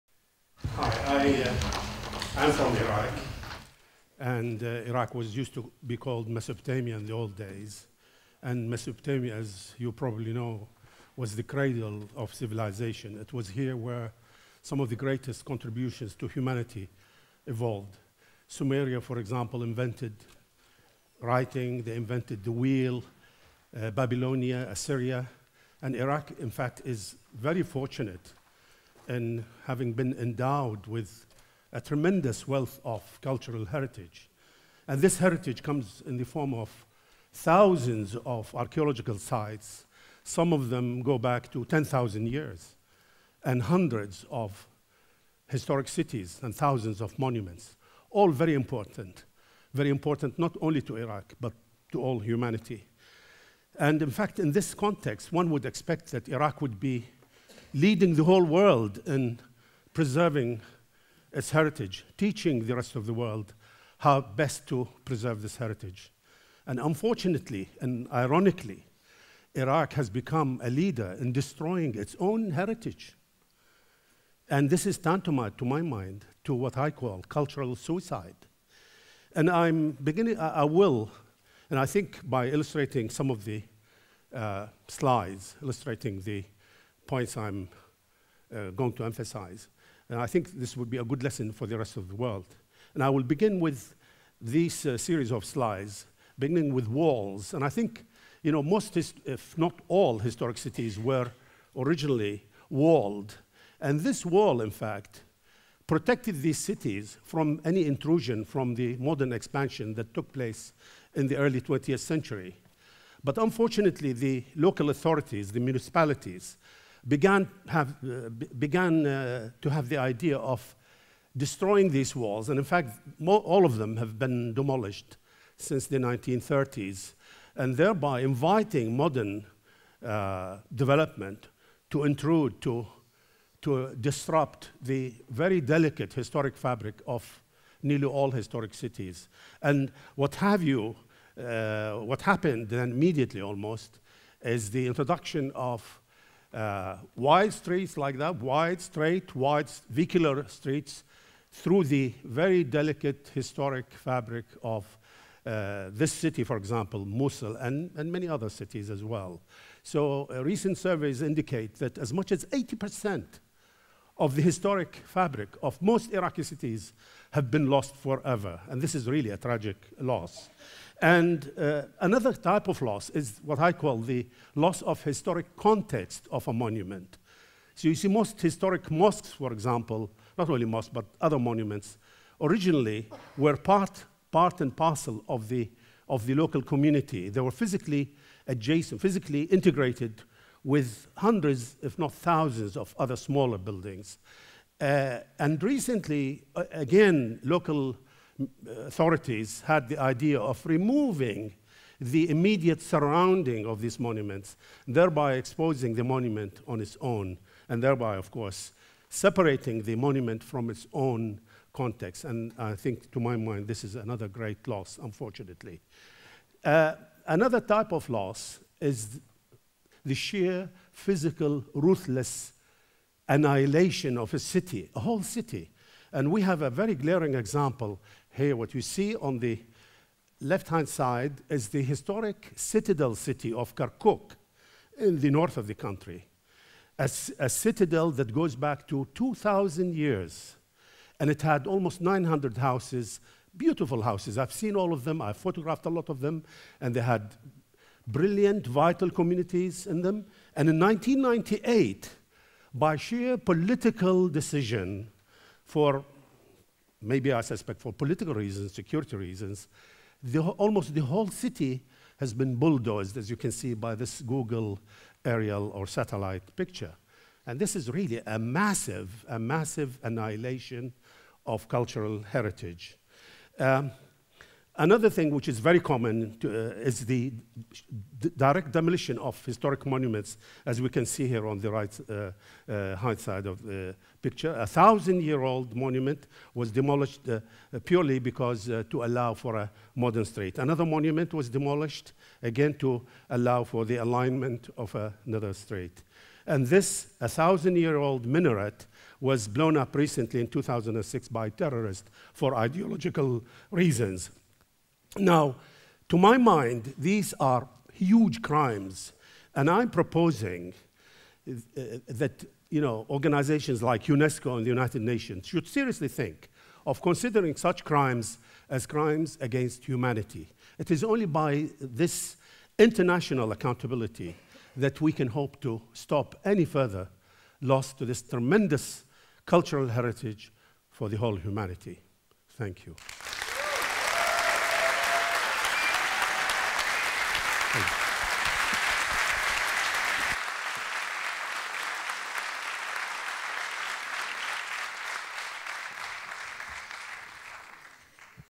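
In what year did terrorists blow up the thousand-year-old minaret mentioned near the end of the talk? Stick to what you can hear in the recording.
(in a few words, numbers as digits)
2006.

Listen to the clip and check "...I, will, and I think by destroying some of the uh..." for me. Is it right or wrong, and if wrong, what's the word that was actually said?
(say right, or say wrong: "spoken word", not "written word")
wrong: "illustrating", not "destroying".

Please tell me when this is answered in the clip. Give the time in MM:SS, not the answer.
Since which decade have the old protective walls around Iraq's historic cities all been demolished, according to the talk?
02:05.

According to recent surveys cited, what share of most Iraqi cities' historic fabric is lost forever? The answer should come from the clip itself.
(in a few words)
80 percent.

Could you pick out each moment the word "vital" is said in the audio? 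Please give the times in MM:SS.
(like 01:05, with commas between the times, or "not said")
04:08.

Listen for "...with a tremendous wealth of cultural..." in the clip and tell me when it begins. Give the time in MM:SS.
00:30.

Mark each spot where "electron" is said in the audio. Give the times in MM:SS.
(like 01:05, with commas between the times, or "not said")
not said.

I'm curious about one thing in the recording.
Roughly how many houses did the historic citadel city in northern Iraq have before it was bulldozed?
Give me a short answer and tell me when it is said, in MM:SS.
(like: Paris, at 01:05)
900, at 04:02.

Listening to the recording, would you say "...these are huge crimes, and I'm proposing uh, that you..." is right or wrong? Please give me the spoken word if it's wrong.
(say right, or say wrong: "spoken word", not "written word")
right.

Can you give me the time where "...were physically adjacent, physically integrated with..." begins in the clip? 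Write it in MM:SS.
03:07.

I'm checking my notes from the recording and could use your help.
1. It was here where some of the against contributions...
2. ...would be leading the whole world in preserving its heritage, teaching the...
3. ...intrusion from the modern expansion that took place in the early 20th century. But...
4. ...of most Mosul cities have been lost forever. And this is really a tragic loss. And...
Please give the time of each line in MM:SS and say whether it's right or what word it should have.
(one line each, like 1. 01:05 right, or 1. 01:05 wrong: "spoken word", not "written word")
1. 00:13 wrong: "greatest", not "against"
2. 00:56 right
3. 01:47 right
4. 02:45 wrong: "Iraqi", not "Mosul".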